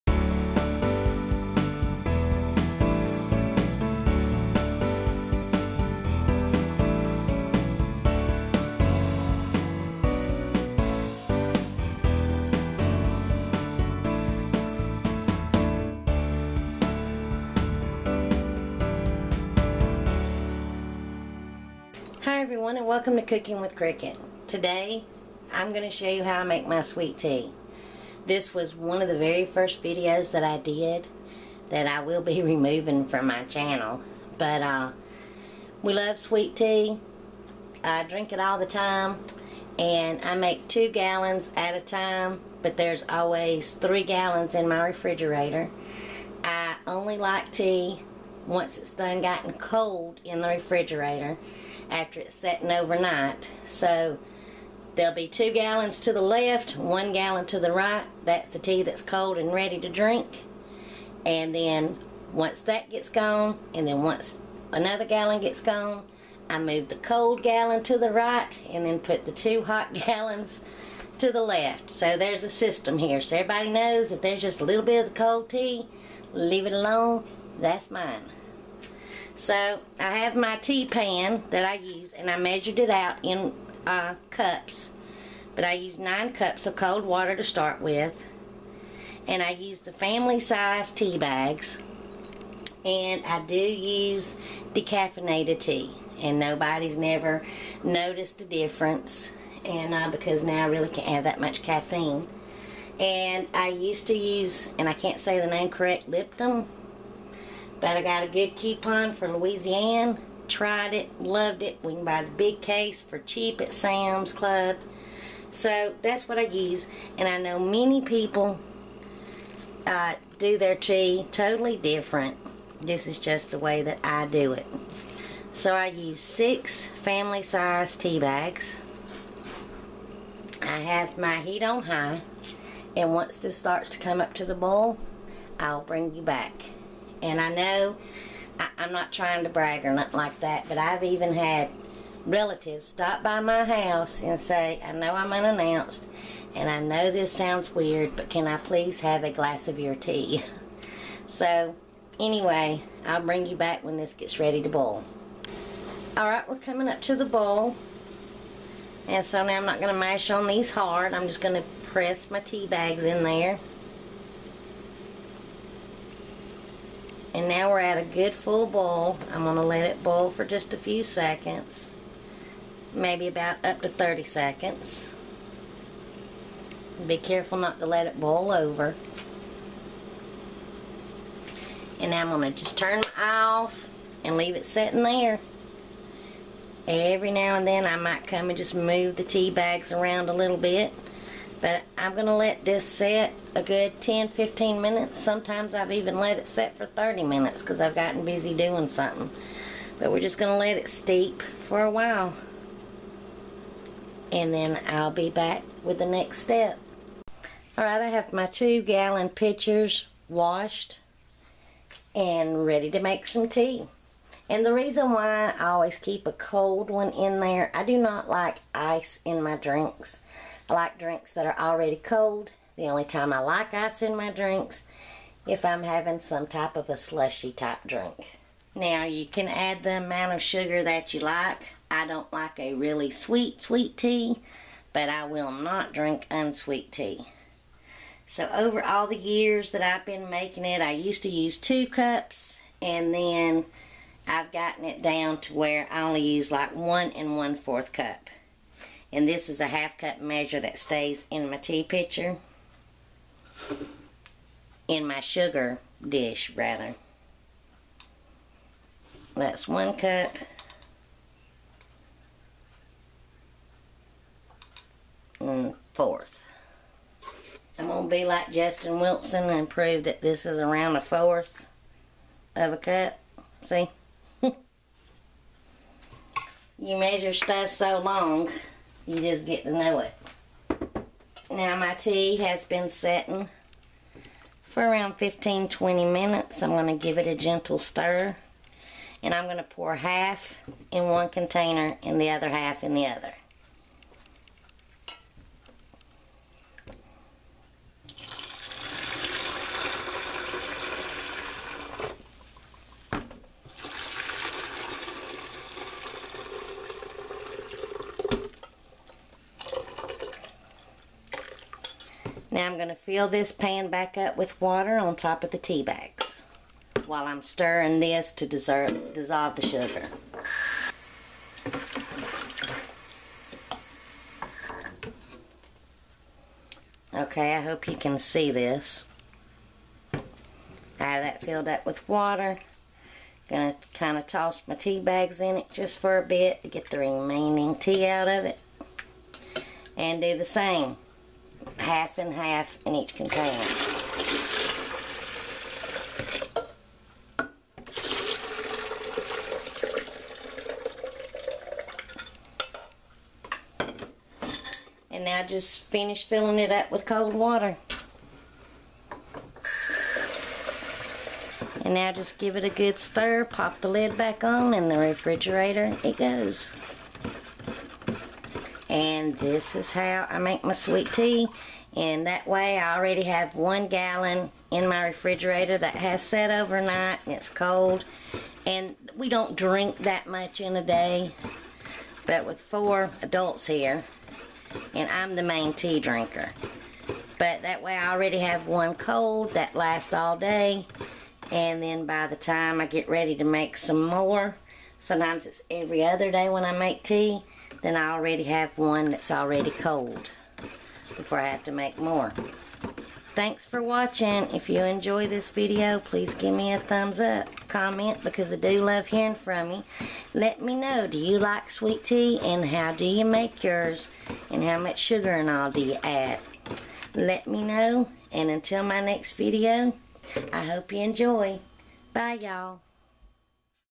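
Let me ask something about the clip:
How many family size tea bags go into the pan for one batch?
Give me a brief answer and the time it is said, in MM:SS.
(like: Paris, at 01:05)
6, at 02:06.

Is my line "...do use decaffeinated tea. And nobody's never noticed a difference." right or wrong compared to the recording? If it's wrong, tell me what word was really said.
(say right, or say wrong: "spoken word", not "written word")
right.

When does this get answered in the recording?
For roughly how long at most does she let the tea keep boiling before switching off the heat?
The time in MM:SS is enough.
02:53.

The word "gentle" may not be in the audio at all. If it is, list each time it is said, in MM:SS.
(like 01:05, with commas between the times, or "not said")
04:47.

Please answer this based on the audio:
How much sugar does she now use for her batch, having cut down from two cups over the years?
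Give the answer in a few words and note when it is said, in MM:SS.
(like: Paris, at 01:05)
1 1/4 cups, at 04:06.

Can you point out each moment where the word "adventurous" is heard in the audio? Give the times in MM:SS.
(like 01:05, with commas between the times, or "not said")
not said.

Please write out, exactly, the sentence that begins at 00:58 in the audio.
That's the tea that's cold and ready to drink.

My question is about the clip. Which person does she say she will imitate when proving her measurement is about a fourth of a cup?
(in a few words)
Justin Wilson.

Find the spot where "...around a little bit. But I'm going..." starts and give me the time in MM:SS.
03:09.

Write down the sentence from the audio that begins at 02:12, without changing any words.
And once this starts to come up to the boil, I'll bring you back.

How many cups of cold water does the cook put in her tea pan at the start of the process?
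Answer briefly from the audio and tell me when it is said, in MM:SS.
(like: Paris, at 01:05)
9 cups, at 01:25.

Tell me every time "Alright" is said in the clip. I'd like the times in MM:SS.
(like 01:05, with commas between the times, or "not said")
02:36, 03:27.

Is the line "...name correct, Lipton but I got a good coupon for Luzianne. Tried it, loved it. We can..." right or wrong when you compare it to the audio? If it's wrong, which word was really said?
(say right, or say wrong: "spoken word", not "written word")
right.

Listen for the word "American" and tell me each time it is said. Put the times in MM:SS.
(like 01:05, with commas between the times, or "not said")
not said.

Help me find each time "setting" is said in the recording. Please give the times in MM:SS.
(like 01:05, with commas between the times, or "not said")
00:52, 04:42.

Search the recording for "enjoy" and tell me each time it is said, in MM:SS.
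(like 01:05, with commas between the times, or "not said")
06:44, 07:00.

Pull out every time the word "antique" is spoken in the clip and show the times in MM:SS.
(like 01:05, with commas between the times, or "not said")
not said.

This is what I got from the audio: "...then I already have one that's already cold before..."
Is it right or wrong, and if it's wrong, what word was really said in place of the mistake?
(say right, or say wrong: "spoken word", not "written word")
right.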